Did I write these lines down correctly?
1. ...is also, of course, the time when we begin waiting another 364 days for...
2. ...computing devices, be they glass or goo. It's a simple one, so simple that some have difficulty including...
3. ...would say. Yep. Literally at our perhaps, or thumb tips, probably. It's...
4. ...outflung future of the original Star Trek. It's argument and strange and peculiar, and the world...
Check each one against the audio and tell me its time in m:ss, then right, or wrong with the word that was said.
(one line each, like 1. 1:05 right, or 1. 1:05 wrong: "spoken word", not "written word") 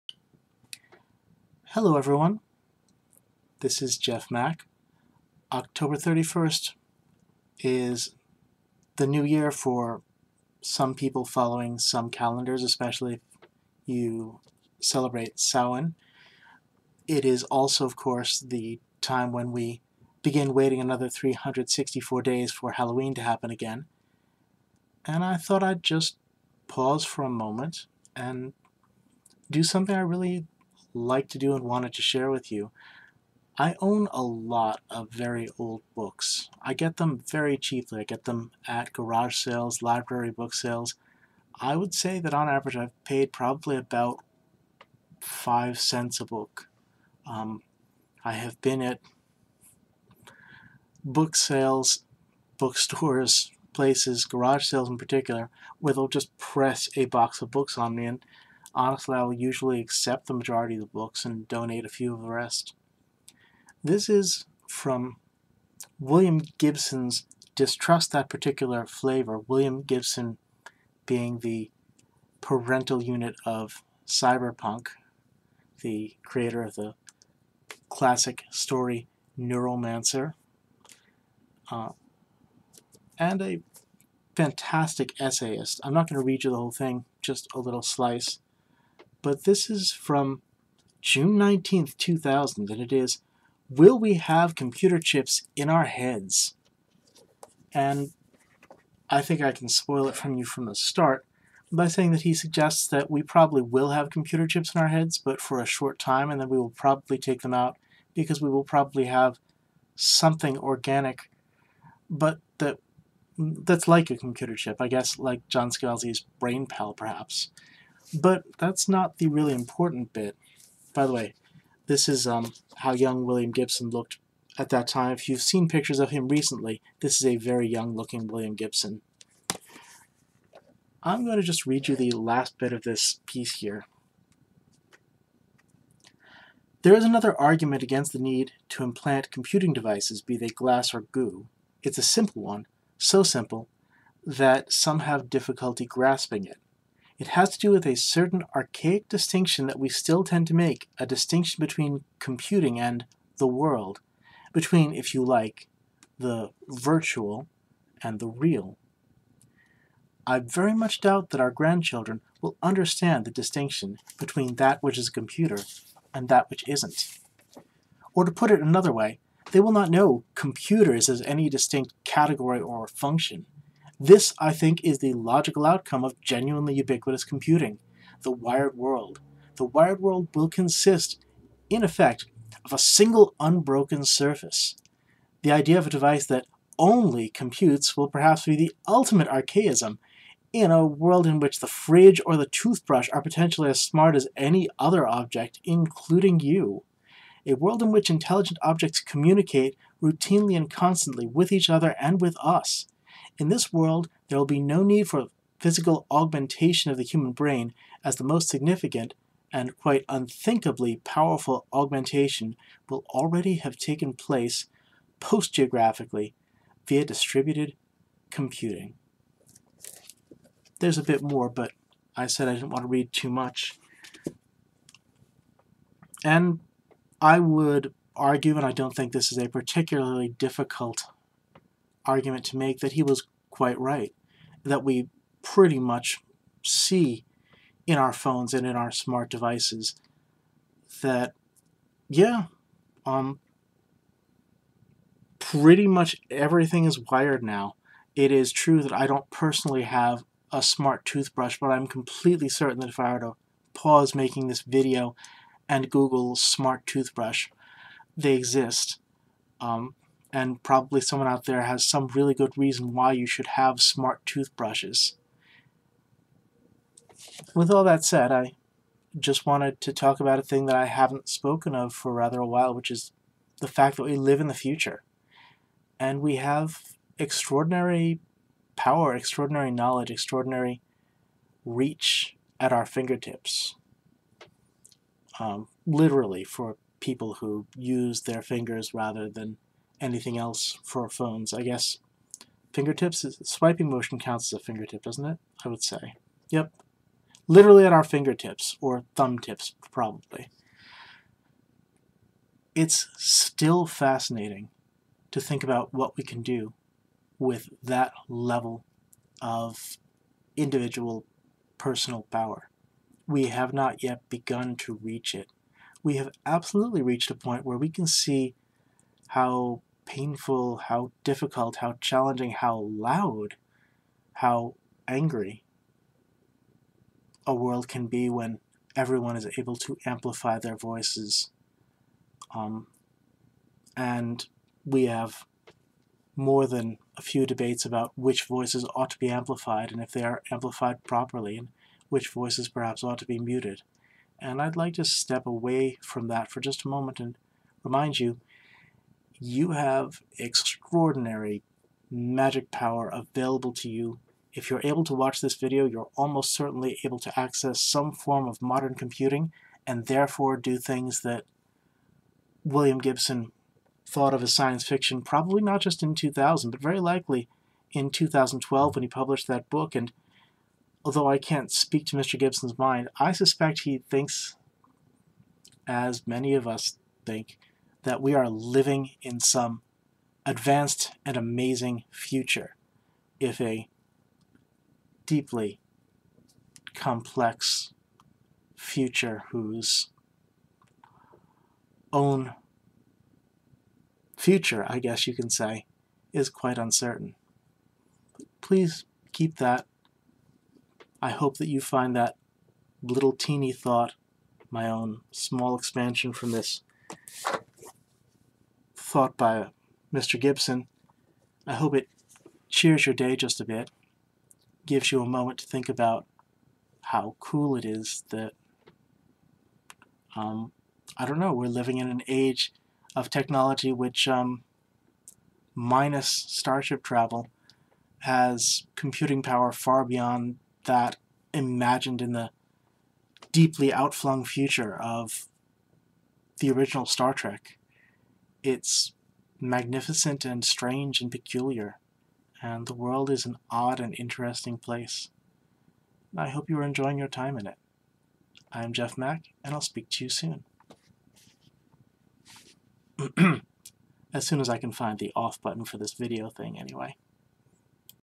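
1. 0:17 right
2. 2:19 wrong: "grasping", not "including"
3. 4:55 wrong: "fingertips", not "perhaps"
4. 7:13 wrong: "magnificent", not "argument".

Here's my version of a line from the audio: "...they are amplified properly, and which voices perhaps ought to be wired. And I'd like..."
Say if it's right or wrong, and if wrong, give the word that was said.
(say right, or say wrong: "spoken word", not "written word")
wrong: "muted", not "wired".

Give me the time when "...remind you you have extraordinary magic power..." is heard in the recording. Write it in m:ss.
5:47.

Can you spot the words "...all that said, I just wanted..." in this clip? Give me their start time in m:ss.
4:27.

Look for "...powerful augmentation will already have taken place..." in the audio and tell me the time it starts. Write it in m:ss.
3:31.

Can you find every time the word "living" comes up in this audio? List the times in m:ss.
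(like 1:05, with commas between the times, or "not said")
6:18, 7:01.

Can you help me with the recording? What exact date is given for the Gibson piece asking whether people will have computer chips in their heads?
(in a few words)
June 19th, 2000.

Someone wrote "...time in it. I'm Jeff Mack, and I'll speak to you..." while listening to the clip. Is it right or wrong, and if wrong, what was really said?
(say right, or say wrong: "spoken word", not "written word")
right.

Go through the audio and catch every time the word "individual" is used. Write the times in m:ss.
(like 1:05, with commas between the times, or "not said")
5:10.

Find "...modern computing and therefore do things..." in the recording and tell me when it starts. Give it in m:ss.
5:58.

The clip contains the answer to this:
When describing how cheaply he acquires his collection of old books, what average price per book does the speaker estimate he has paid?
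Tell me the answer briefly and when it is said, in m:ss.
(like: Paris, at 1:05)
5 cents, at 0:45.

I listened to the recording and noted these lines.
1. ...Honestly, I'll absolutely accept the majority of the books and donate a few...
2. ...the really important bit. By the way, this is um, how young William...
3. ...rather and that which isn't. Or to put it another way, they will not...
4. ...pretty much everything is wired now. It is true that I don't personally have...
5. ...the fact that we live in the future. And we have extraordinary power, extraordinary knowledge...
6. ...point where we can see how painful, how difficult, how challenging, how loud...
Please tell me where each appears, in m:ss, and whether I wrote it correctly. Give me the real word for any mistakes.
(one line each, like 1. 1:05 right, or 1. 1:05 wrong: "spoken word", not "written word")
1. 0:58 wrong: "usually", not "absolutely"
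2. 1:59 right
3. 2:45 wrong: "computer", not "rather"
4. 4:05 right
5. 4:33 right
6. 5:17 right.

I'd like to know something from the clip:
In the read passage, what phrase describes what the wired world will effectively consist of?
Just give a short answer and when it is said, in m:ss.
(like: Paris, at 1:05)
single unbroken surface, at 3:02.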